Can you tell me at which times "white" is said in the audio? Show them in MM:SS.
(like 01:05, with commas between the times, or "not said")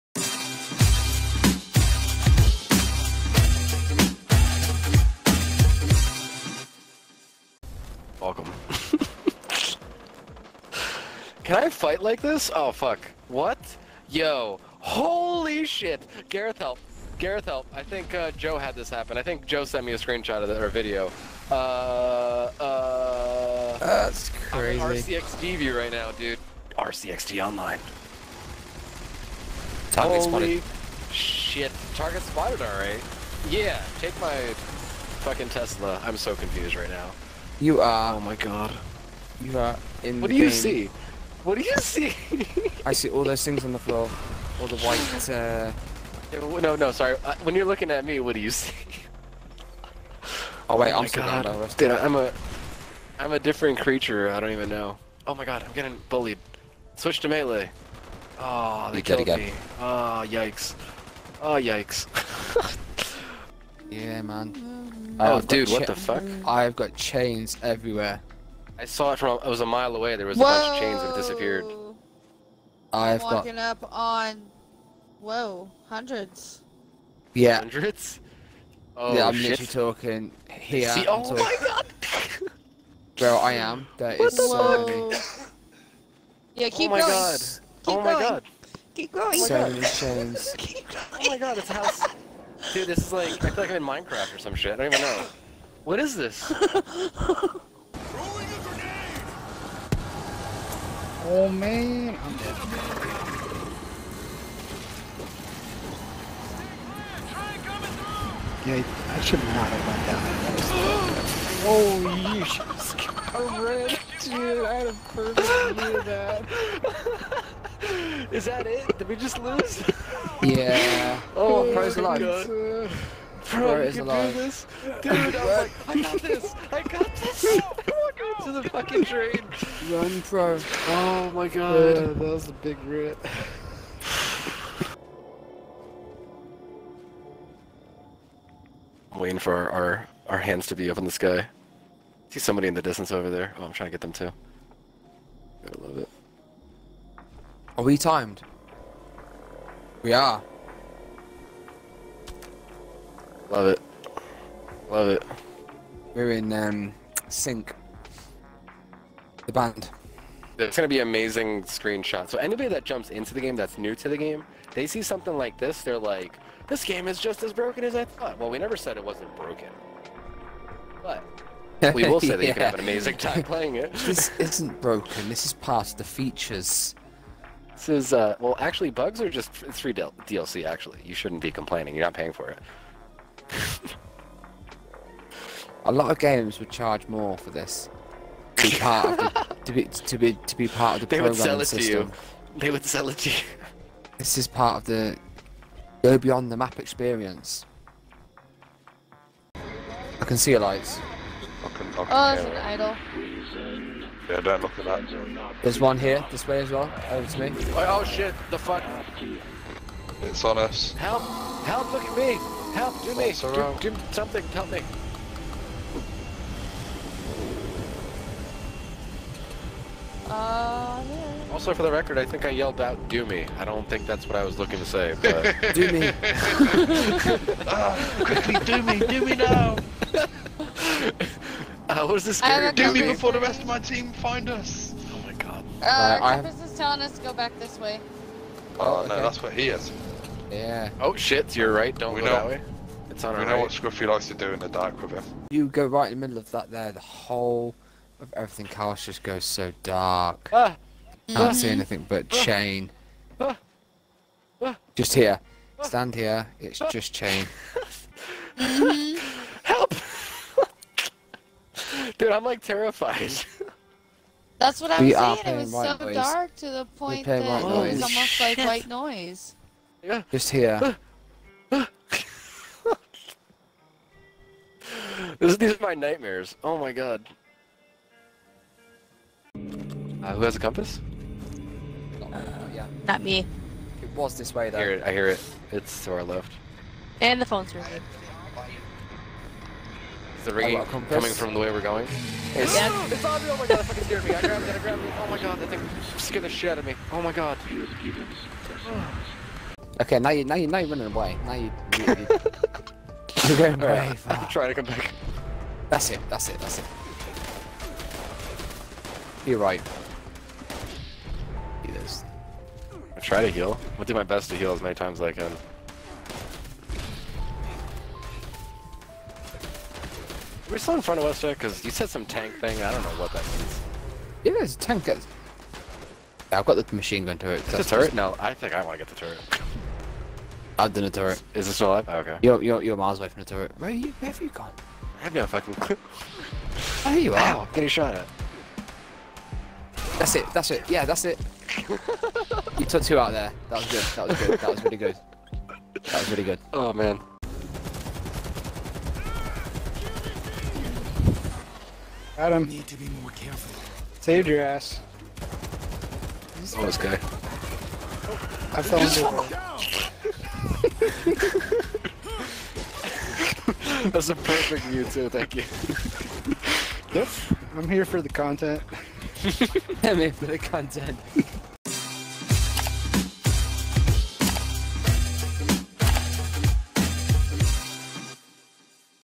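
00:44, 04:28.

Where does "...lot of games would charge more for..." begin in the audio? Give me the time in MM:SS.
03:05.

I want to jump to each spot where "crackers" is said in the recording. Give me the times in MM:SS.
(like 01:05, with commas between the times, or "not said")
not said.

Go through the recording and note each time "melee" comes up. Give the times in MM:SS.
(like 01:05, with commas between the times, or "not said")
00:57.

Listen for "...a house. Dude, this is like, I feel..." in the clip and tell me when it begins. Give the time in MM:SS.
01:31.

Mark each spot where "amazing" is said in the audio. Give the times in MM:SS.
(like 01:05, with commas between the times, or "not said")
02:40, 02:52.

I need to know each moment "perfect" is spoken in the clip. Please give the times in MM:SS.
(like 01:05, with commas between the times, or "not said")
01:55, 06:04.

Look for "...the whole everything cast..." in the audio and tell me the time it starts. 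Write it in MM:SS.
04:06.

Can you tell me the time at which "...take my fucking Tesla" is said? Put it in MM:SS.
00:33.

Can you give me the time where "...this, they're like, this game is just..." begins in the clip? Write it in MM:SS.
02:45.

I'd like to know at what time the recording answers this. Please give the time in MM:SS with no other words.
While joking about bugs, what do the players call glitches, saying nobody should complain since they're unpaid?
02:59.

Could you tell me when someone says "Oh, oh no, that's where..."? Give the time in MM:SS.
03:58.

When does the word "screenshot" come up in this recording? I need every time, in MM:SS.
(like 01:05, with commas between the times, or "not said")
00:19, 02:41.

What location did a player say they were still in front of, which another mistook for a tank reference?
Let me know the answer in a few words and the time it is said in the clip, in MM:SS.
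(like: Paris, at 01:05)
West Tek, at 05:21.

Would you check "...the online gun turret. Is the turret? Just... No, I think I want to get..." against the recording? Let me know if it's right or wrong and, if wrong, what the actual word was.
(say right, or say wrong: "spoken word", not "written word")
wrong: "machine", not "online".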